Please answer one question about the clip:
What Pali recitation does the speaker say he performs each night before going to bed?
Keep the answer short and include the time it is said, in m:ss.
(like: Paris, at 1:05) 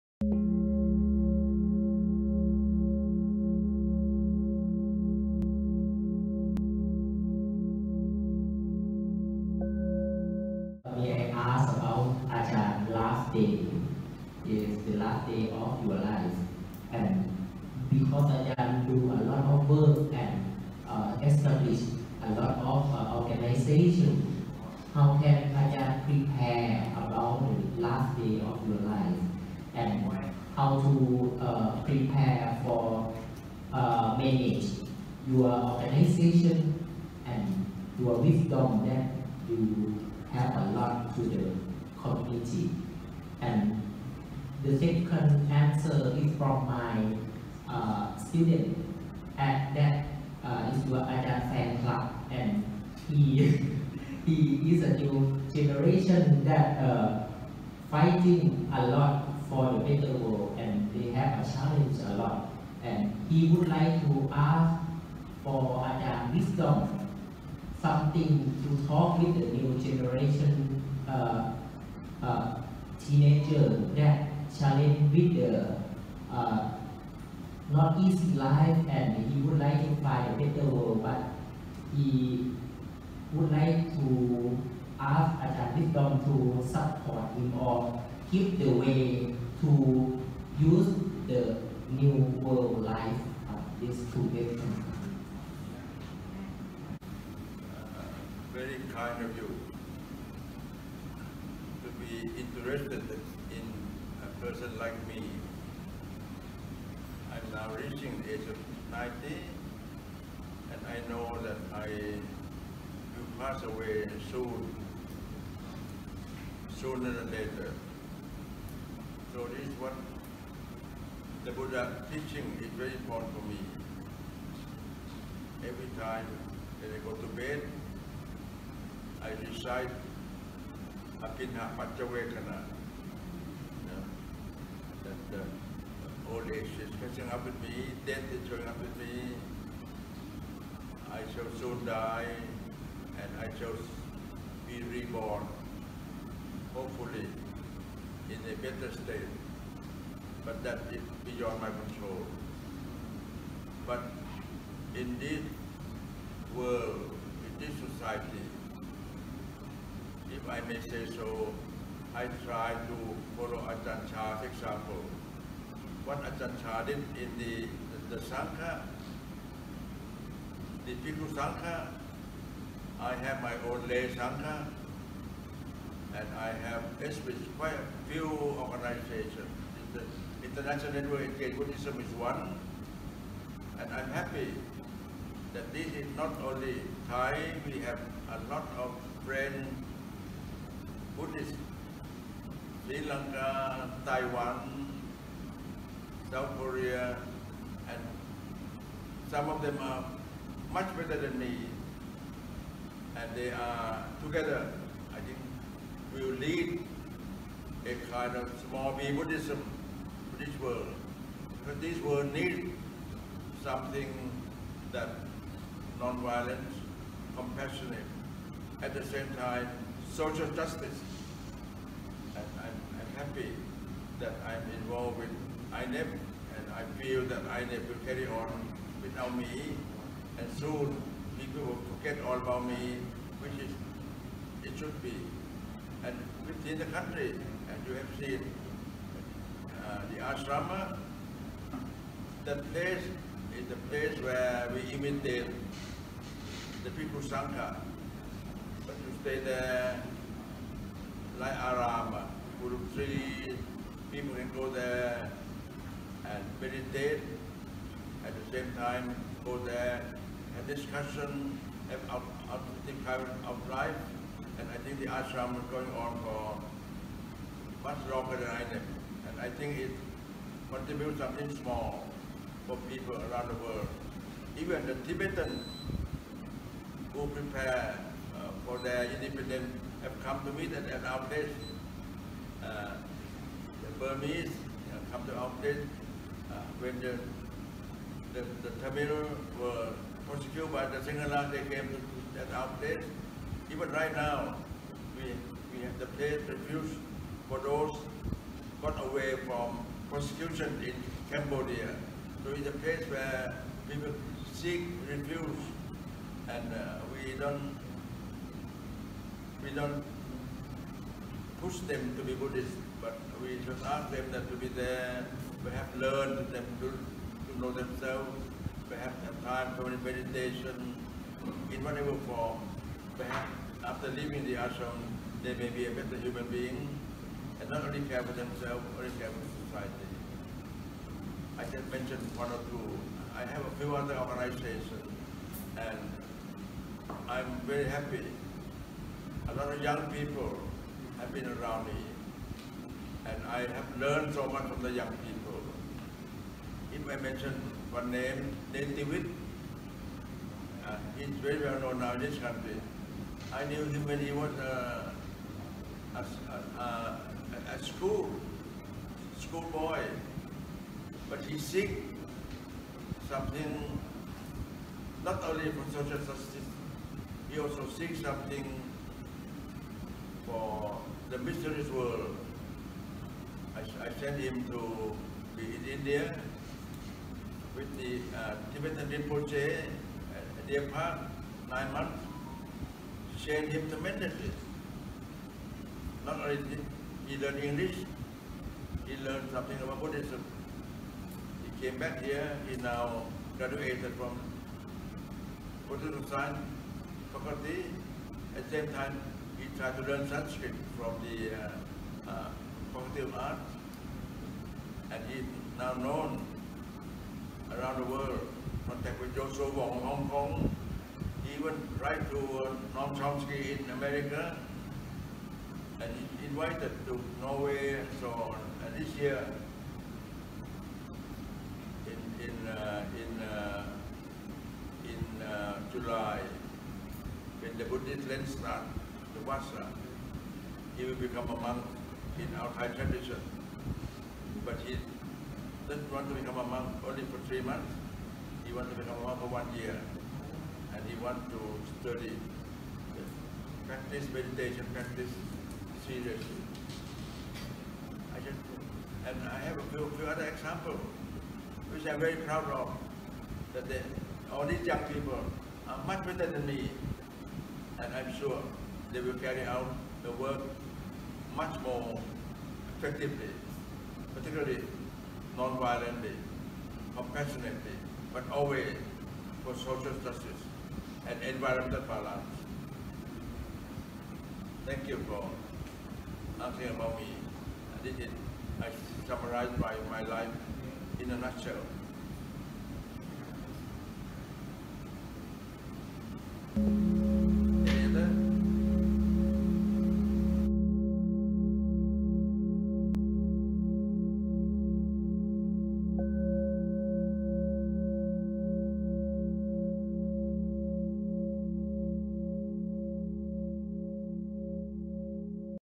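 Abhinha Paccavekkhana, at 2:11.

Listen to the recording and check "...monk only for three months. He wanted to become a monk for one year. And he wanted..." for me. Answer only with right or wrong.
right.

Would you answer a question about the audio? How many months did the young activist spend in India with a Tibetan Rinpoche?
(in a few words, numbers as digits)
9.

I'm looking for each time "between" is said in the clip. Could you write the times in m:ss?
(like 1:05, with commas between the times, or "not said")
not said.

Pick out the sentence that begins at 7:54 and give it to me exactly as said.
Thank you for asking about me.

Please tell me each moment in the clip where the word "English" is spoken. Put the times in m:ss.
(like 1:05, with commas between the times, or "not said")
6:27.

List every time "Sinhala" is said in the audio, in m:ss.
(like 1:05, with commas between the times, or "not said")
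4:50.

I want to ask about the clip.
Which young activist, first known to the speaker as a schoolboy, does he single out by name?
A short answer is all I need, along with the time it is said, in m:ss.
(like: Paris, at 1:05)
Netivit, at 5:48.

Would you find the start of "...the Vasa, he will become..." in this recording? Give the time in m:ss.
7:09.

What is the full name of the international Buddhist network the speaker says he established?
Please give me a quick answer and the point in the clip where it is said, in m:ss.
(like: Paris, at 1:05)
International Network Engaged Buddhism, at 3:00.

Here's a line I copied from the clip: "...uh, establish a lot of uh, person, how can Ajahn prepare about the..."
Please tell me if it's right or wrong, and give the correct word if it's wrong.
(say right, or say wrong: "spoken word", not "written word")
wrong: "organization", not "person".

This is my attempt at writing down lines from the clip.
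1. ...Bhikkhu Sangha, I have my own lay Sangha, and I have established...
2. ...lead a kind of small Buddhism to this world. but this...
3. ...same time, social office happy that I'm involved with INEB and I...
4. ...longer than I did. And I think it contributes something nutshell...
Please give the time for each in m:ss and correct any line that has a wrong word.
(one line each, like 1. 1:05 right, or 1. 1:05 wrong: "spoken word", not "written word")
1. 2:50 right
2. 3:26 right
3. 3:39 wrong: "justice", not "office"
4. 4:28 wrong: "small", not "nutshell".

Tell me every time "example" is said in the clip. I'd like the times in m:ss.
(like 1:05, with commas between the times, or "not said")
2:44, 7:30.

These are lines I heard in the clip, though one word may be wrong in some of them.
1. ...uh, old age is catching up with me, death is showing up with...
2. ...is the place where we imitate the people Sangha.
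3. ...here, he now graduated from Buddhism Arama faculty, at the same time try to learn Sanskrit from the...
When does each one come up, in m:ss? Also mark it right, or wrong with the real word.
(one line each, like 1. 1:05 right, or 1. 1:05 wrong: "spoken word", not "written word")
1. 2:15 right
2. 4:03 right
3. 6:32 wrong: "Science", not "Arama".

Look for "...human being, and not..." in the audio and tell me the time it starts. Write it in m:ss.
5:26.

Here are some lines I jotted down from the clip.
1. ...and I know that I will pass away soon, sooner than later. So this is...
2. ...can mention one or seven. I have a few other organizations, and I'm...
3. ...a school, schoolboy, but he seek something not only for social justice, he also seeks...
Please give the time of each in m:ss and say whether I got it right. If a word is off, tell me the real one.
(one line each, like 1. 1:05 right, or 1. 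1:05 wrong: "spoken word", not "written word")
1. 1:50 right
2. 5:31 wrong: "two", not "seven"
3. 5:57 right.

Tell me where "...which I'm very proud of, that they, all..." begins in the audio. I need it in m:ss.
7:31.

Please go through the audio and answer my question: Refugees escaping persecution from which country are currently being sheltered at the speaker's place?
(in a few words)
Cambodia.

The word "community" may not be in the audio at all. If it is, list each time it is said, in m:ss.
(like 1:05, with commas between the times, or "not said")
0:42.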